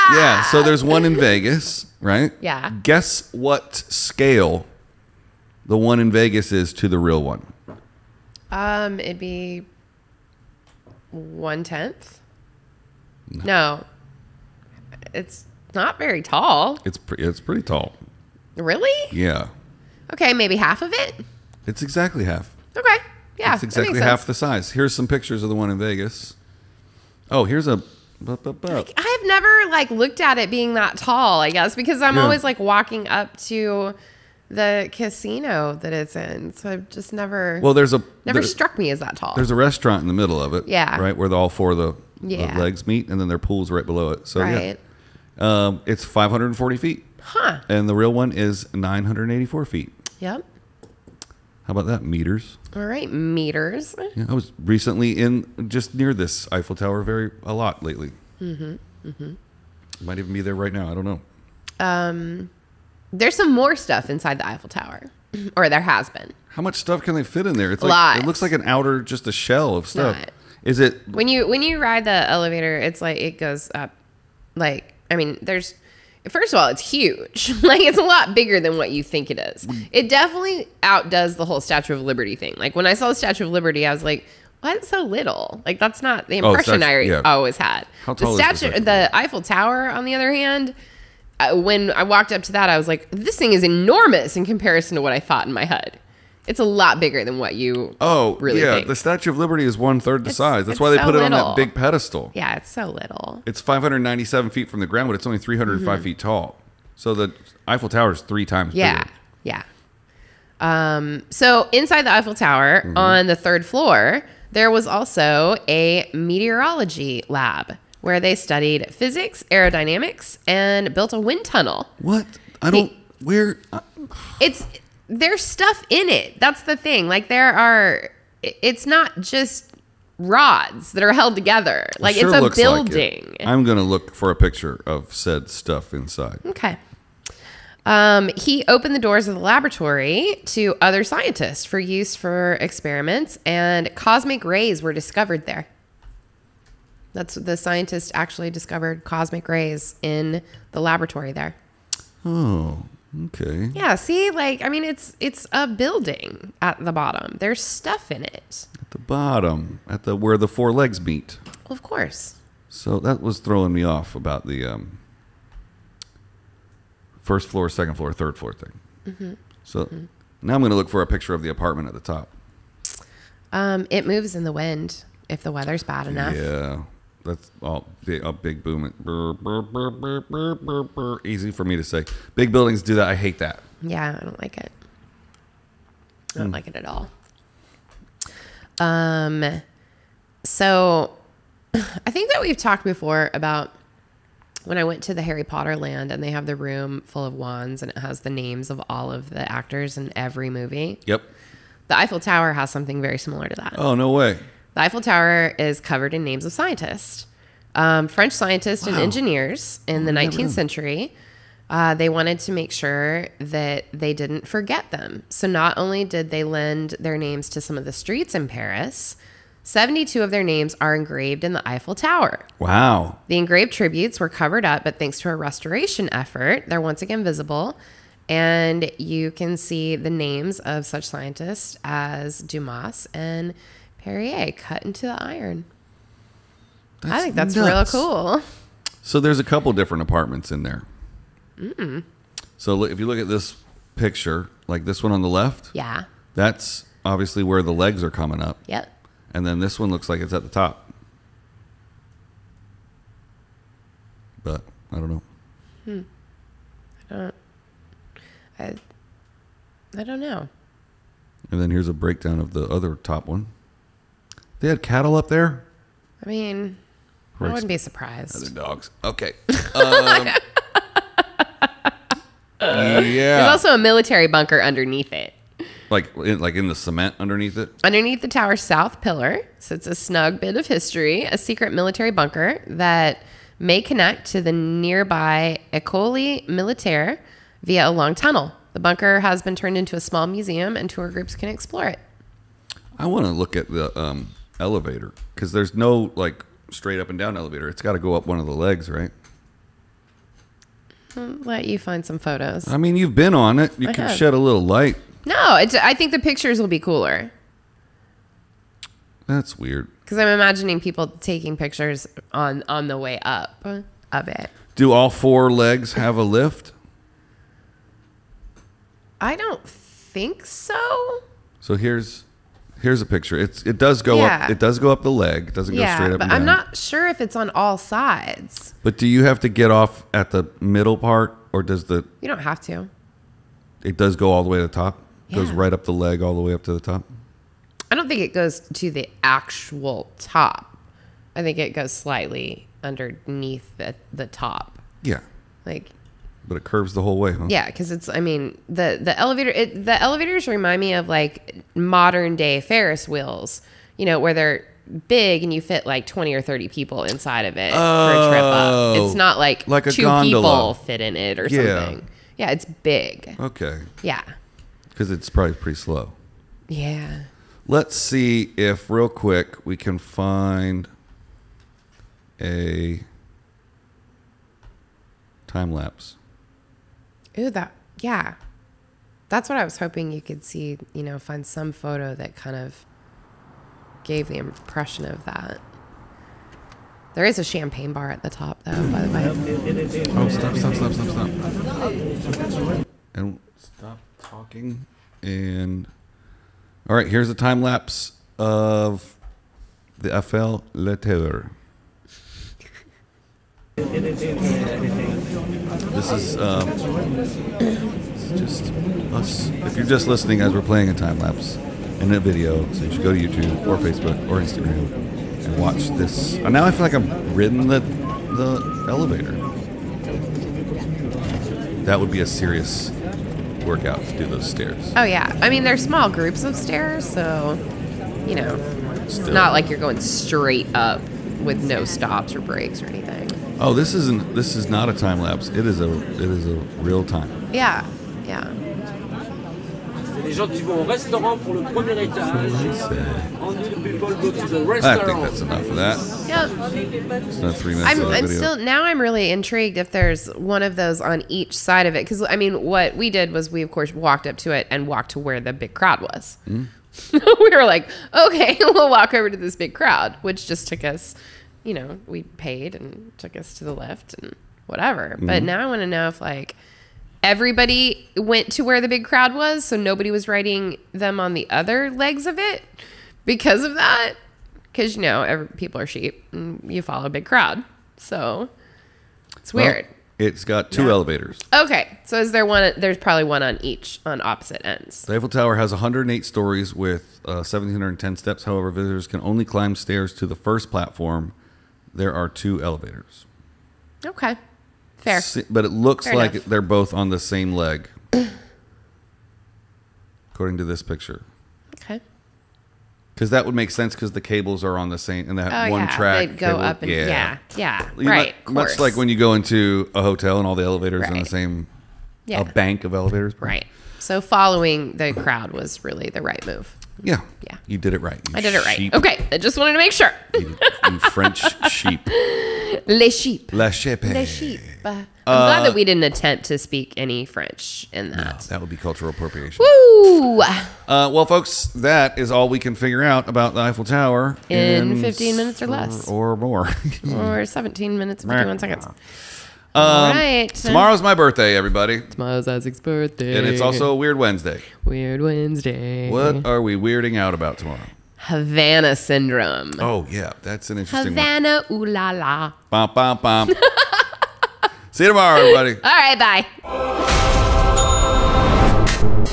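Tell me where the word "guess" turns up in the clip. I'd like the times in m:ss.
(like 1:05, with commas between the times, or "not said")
0:02, 0:31.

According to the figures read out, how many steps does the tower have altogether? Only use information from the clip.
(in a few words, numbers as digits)
1,710.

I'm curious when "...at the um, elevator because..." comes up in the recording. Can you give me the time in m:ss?
4:53.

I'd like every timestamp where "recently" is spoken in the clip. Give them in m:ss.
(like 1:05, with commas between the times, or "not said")
0:54.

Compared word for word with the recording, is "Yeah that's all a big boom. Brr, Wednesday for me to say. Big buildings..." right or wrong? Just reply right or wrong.
wrong.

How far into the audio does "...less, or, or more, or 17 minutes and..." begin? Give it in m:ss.
8:55.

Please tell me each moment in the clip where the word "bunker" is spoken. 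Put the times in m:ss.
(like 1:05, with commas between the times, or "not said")
4:34, 4:42, 4:48.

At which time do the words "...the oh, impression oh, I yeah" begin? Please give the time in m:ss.
1:26.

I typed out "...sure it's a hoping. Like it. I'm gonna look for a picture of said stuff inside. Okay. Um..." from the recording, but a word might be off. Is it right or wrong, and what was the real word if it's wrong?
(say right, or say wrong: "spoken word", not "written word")
wrong: "building", not "hoping".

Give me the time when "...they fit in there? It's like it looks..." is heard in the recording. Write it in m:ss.
1:07.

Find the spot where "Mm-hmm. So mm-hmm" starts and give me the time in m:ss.
2:49.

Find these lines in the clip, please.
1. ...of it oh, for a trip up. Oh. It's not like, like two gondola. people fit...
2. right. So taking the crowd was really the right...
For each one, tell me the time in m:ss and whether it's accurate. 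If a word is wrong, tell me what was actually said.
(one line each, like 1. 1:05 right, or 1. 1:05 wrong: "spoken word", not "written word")
1. 5:57 right
2. 8:33 wrong: "following", not "taking".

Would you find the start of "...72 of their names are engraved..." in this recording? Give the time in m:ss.
3:39.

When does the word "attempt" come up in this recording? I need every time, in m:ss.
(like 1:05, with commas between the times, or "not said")
8:46.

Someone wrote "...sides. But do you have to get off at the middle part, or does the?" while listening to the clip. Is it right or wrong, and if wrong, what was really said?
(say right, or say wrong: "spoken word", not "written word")
right.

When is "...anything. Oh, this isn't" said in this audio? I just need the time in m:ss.
7:12.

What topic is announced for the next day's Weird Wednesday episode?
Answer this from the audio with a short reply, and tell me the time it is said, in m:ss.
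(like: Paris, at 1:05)
Havana syndrome, at 9:08.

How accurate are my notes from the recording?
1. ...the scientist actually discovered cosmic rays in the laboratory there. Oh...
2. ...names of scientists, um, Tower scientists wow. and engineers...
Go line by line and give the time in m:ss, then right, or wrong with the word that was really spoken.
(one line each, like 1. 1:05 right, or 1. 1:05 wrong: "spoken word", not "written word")
1. 2:27 right
2. 3:26 wrong: "French", not "Tower".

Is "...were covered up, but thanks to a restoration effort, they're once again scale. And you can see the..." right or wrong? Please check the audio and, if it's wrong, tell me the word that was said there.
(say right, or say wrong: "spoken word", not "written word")
wrong: "visible", not "scale".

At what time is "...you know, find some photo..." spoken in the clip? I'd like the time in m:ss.
6:20.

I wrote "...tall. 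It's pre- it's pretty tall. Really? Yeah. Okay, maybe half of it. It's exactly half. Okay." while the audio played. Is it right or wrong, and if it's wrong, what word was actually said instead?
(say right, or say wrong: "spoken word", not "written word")
right.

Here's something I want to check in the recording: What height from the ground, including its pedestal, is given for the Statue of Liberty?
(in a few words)
597 feet.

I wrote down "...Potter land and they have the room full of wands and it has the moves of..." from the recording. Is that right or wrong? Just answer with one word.
wrong.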